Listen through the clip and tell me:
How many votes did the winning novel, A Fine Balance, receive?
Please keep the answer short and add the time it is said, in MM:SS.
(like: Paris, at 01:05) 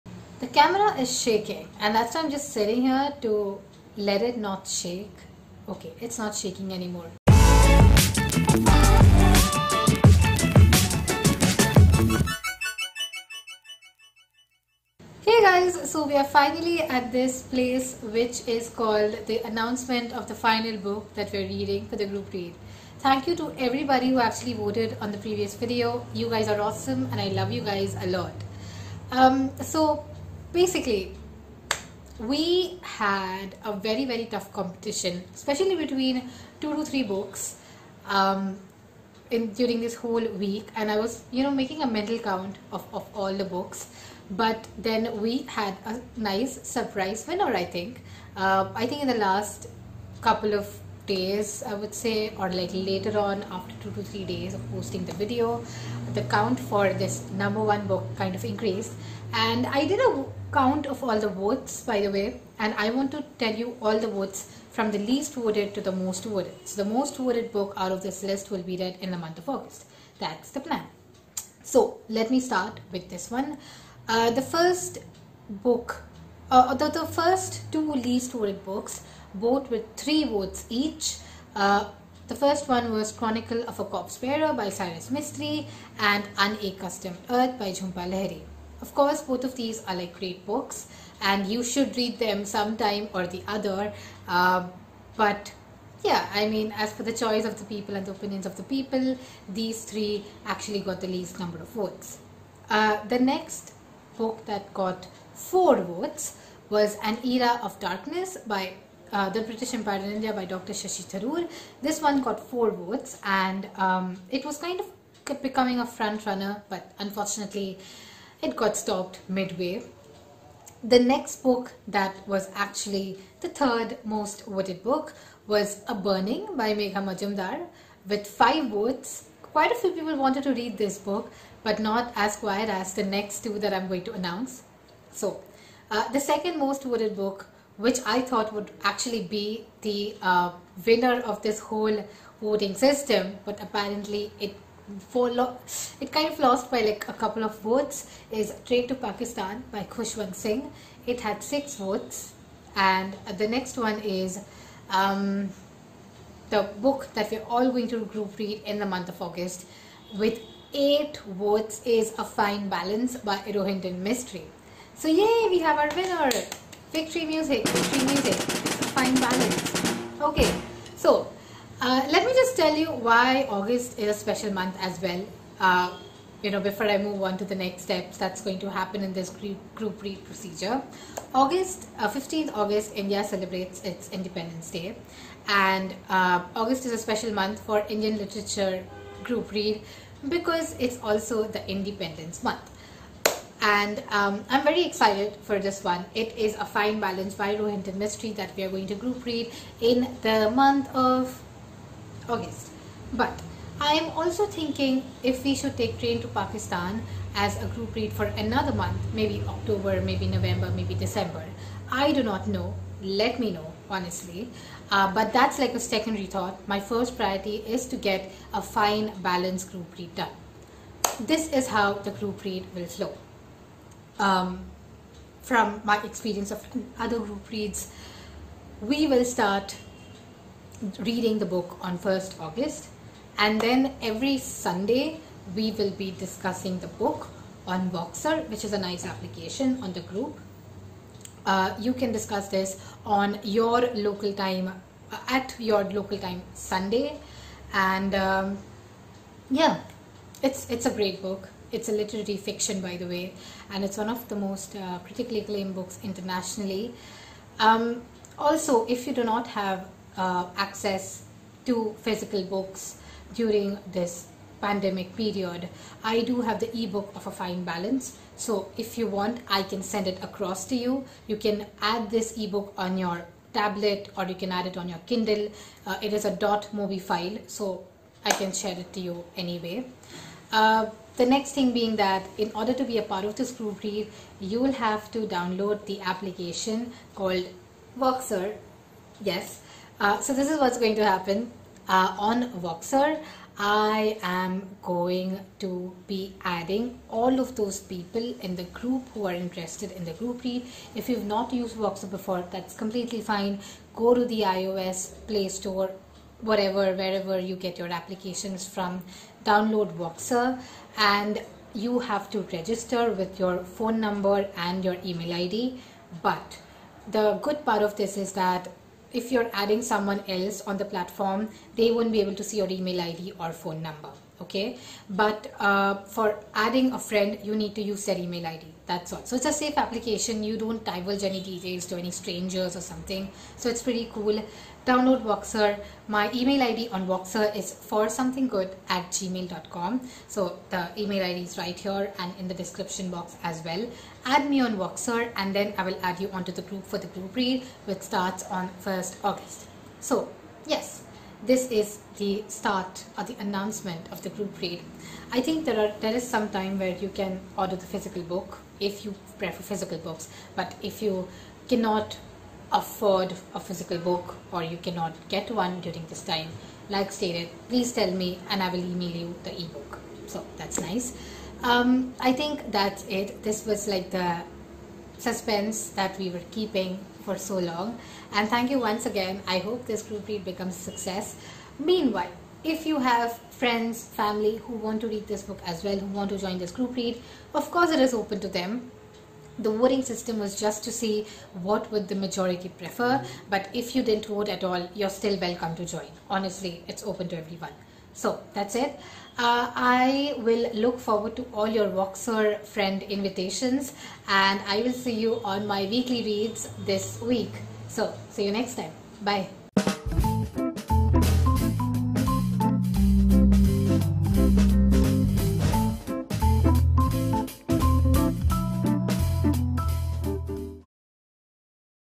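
8, at 02:40.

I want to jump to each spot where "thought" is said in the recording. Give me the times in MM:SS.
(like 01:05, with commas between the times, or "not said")
02:18, 03:36.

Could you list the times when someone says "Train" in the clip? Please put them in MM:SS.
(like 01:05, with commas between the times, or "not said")
02:28, 03:25.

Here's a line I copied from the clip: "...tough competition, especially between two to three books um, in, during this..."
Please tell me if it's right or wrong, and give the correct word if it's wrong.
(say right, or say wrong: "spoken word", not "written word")
right.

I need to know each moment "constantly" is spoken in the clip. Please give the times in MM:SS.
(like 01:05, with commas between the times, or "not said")
not said.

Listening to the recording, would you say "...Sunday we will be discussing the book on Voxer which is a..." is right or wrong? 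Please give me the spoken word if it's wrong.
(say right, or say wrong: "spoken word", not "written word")
right.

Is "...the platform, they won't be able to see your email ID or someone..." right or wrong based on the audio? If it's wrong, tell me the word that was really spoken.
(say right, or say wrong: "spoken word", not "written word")
wrong: "phone", not "someone".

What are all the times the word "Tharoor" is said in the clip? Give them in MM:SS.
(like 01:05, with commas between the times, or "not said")
01:51.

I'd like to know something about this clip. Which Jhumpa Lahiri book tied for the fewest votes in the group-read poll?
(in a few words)
Unaccustomed Earth.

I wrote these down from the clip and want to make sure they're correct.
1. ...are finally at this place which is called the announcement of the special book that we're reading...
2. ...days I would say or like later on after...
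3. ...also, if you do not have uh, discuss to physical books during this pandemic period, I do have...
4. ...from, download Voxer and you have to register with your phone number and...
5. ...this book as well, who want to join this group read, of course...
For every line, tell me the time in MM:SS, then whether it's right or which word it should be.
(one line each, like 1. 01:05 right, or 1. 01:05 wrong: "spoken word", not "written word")
1. 00:16 wrong: "final", not "special"
2. 00:51 right
3. 04:18 wrong: "access", not "discuss"
4. 05:08 right
5. 06:25 right.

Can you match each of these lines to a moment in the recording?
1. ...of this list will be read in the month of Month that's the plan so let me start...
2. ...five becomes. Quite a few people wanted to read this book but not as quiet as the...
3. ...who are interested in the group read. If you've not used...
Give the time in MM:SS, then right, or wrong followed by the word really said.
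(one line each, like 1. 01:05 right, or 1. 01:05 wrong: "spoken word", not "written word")
1. 01:07 wrong: "August", not "Month"
2. 02:08 wrong: "votes", not "becomes"
3. 04:59 right.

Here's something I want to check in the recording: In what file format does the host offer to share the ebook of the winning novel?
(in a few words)
.mobi.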